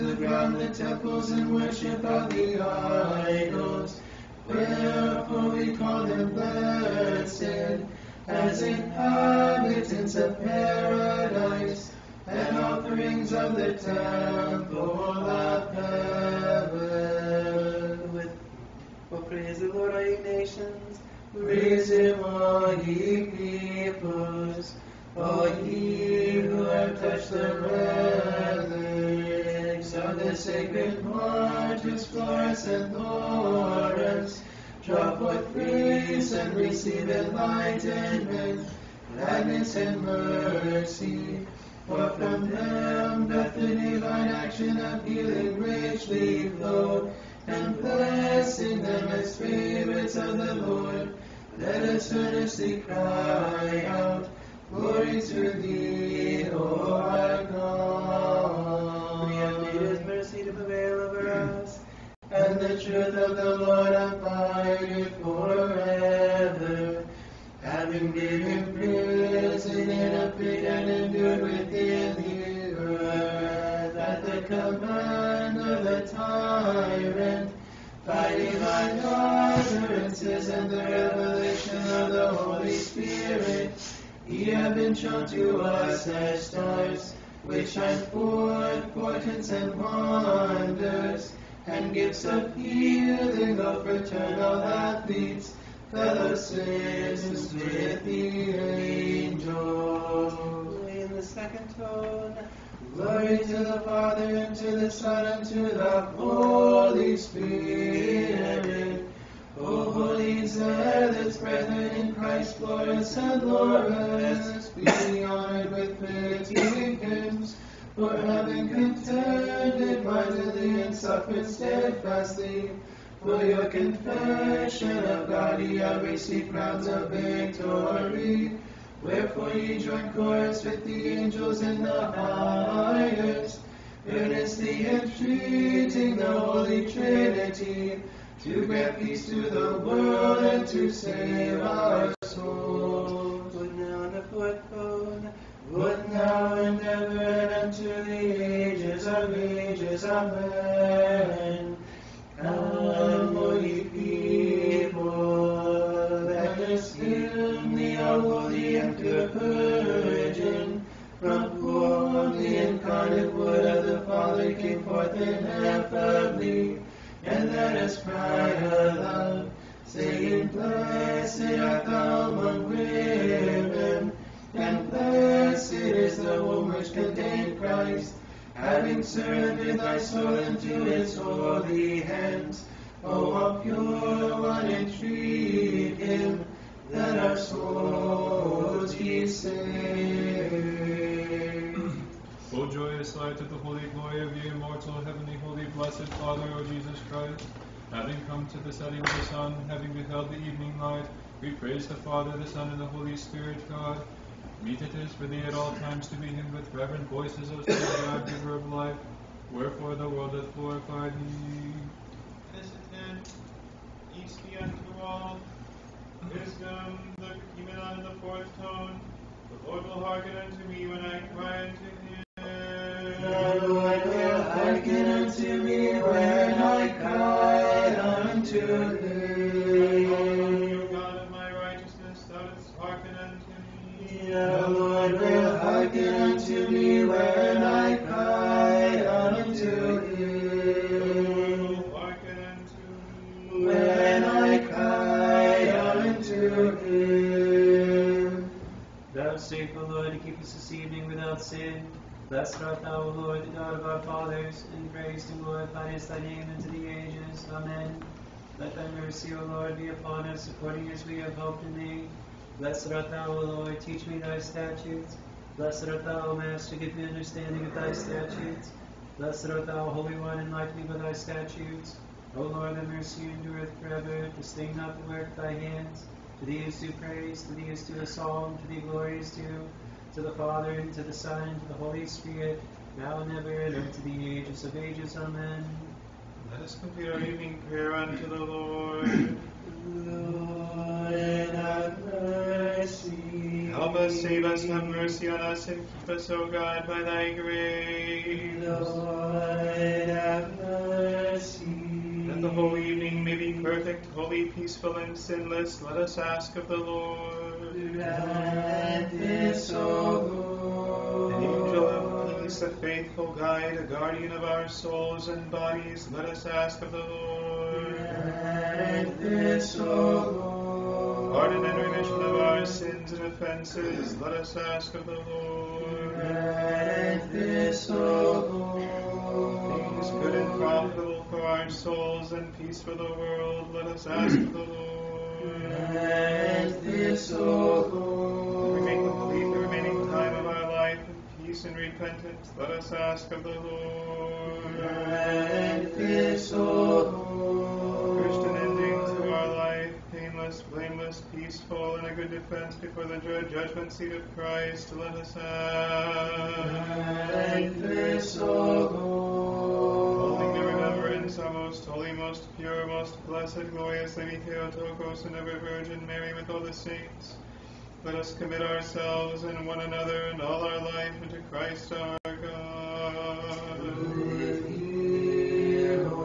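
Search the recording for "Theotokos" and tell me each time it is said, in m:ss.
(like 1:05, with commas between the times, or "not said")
6:04.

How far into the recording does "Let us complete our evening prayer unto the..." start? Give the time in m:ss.
4:46.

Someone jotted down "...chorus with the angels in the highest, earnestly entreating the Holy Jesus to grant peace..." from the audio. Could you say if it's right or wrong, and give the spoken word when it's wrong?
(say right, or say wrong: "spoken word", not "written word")
wrong: "Trinity", not "Jesus".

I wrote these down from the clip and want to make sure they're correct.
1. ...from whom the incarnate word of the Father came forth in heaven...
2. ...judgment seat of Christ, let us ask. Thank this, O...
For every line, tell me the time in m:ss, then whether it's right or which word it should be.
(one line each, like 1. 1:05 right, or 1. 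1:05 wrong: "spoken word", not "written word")
1. 2:41 right
2. 5:53 right.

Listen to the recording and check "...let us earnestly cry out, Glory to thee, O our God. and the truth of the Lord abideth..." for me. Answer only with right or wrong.
right.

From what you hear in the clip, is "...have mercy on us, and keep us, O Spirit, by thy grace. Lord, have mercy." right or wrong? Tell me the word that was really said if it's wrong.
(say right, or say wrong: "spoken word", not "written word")
wrong: "God", not "Spirit".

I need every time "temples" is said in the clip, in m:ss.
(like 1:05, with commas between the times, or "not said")
0:00, 0:13.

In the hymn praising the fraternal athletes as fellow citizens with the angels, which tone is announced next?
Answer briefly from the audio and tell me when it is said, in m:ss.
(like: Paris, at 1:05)
Second tone, at 1:41.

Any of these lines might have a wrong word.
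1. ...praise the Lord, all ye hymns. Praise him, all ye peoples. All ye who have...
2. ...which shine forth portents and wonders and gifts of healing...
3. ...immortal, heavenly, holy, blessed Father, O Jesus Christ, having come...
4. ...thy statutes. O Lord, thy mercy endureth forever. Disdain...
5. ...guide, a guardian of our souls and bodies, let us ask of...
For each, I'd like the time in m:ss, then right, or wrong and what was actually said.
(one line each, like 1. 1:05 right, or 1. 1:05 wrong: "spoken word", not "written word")
1. 0:19 wrong: "nations", not "hymns"
2. 1:27 right
3. 3:14 right
4. 4:30 right
5. 5:13 right.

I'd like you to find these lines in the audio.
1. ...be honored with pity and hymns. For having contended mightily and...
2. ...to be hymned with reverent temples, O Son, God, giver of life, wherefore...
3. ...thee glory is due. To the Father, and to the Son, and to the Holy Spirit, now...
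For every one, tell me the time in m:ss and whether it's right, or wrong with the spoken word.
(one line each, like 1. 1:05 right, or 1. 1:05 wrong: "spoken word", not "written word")
1. 1:54 right
2. 3:26 wrong: "voices", not "temples"
3. 4:38 right.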